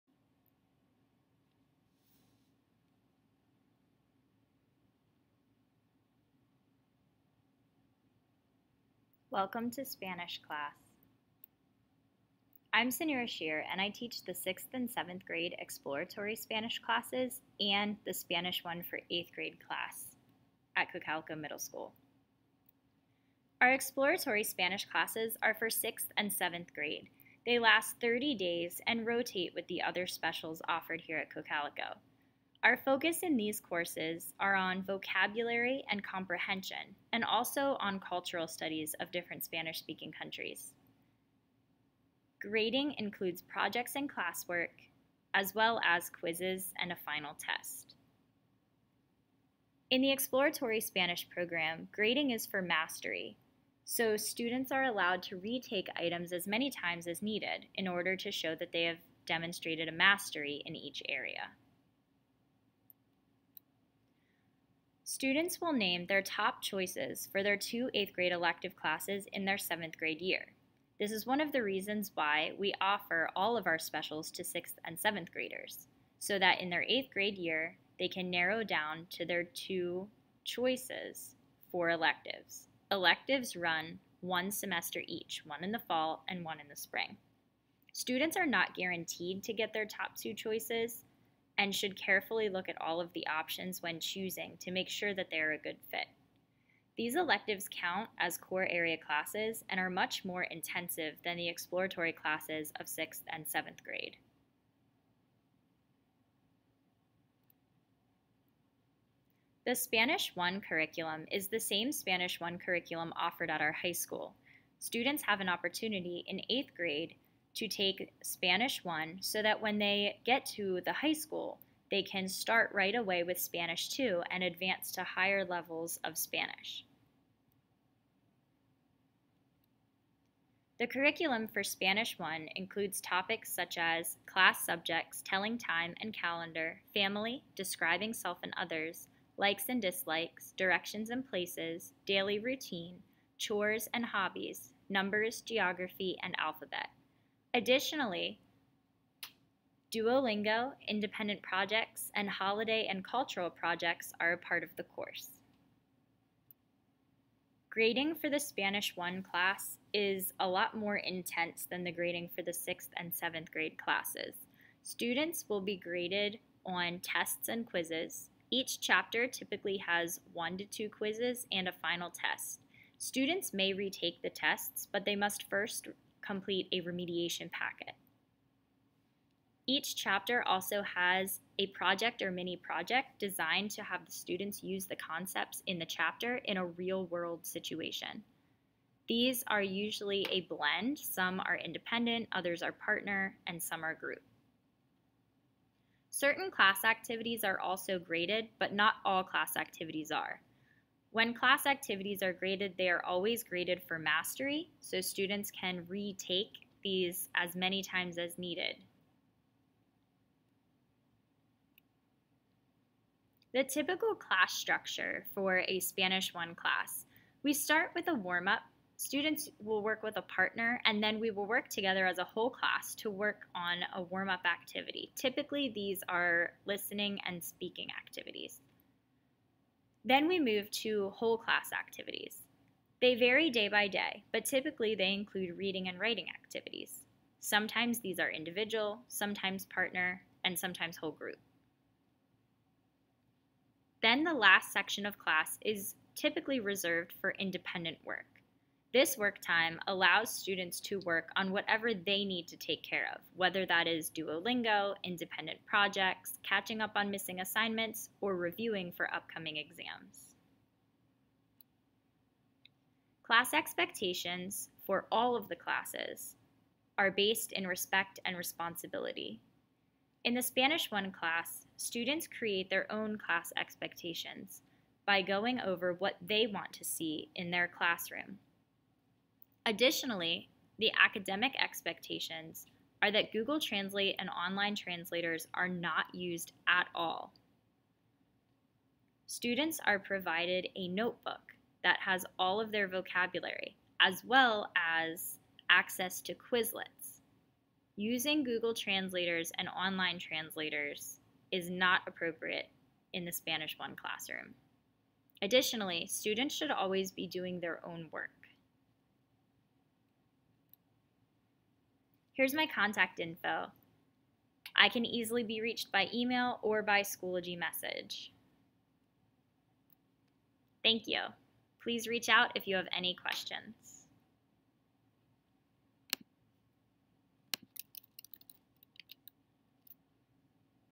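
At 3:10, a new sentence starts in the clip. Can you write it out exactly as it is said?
Some are independent, others are partner, and some are group.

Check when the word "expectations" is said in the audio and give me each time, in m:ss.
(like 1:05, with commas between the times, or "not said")
4:23, 4:33, 4:41.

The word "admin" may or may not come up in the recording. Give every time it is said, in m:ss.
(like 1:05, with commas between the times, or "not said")
not said.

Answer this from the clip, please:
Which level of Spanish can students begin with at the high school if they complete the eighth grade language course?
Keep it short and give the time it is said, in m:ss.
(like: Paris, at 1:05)
Spanish 2, at 2:03.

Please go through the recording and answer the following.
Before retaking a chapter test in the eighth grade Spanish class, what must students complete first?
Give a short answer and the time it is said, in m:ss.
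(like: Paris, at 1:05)
a remediation packet, at 2:56.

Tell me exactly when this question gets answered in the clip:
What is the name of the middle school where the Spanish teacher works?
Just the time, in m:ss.
0:20.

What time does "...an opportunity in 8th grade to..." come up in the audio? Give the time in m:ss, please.
1:55.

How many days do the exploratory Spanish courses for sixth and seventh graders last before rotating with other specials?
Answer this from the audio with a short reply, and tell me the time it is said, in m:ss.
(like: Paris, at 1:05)
30, at 0:28.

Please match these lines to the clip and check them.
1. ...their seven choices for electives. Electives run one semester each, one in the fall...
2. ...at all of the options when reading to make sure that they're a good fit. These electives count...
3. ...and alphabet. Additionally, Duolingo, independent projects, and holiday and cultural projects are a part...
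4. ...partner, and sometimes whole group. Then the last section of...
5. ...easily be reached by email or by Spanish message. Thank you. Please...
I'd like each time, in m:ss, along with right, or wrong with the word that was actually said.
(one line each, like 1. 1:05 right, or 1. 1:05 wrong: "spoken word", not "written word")
1. 1:19 wrong: "two", not "seven"
2. 1:32 wrong: "choosing", not "reading"
3. 2:26 right
4. 3:59 right
5. 5:15 wrong: "Schoology", not "Spanish".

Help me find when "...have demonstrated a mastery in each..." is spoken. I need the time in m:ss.
0:58.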